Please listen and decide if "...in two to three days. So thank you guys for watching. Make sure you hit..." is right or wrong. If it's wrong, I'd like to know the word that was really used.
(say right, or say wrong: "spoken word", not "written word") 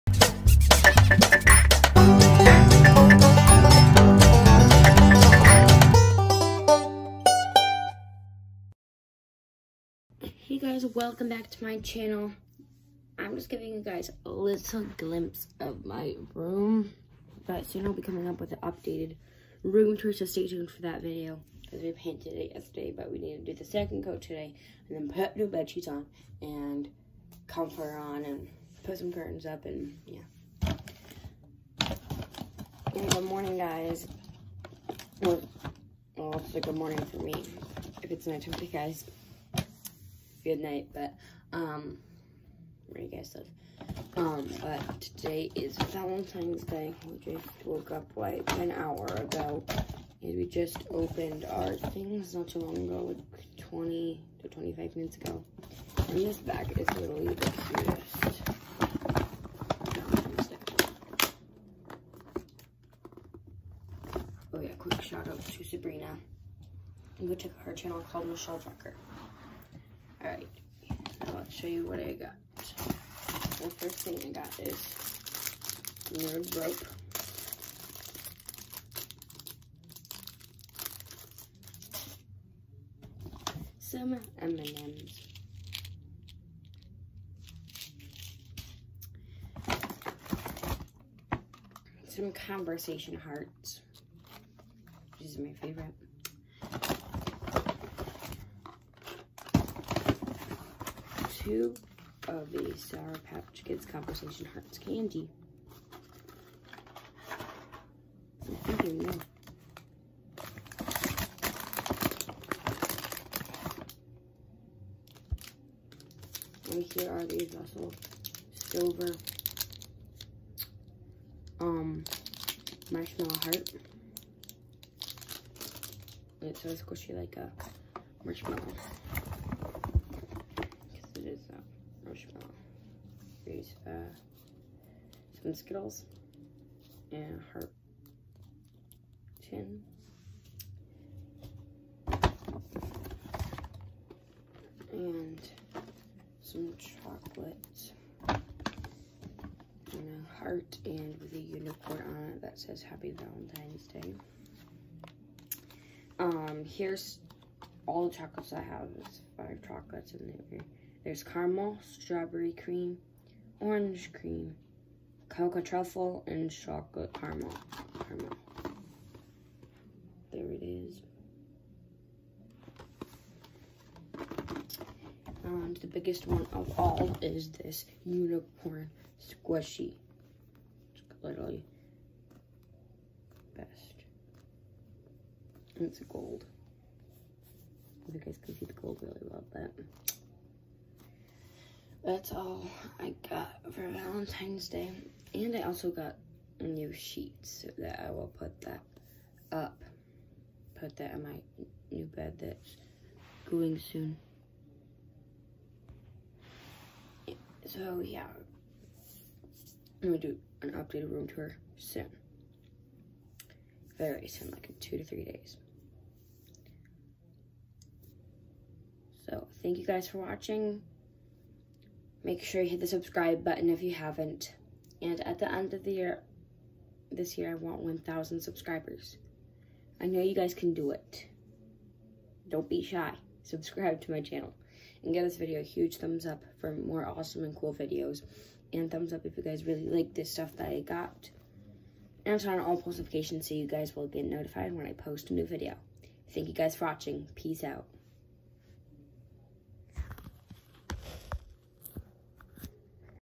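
right.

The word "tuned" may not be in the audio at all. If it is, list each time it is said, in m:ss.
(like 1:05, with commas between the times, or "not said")
0:20.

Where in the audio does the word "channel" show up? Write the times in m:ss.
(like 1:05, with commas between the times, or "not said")
0:11, 1:07, 3:54.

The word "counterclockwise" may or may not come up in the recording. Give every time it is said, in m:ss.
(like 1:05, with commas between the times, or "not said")
not said.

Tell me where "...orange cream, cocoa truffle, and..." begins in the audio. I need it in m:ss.
2:43.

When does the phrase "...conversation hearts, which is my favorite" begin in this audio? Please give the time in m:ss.
1:32.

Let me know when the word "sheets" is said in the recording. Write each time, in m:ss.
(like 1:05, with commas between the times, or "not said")
0:25, 3:16.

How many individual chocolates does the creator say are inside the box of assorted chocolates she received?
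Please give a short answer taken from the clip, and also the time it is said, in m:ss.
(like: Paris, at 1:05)
5, at 2:39.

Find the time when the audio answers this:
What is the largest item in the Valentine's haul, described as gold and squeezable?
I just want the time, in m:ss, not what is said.
2:58.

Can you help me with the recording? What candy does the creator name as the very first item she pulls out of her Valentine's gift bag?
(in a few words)
nerd rope.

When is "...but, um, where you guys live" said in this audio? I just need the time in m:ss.
0:40.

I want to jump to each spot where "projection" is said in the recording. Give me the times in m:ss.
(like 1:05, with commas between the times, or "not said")
not said.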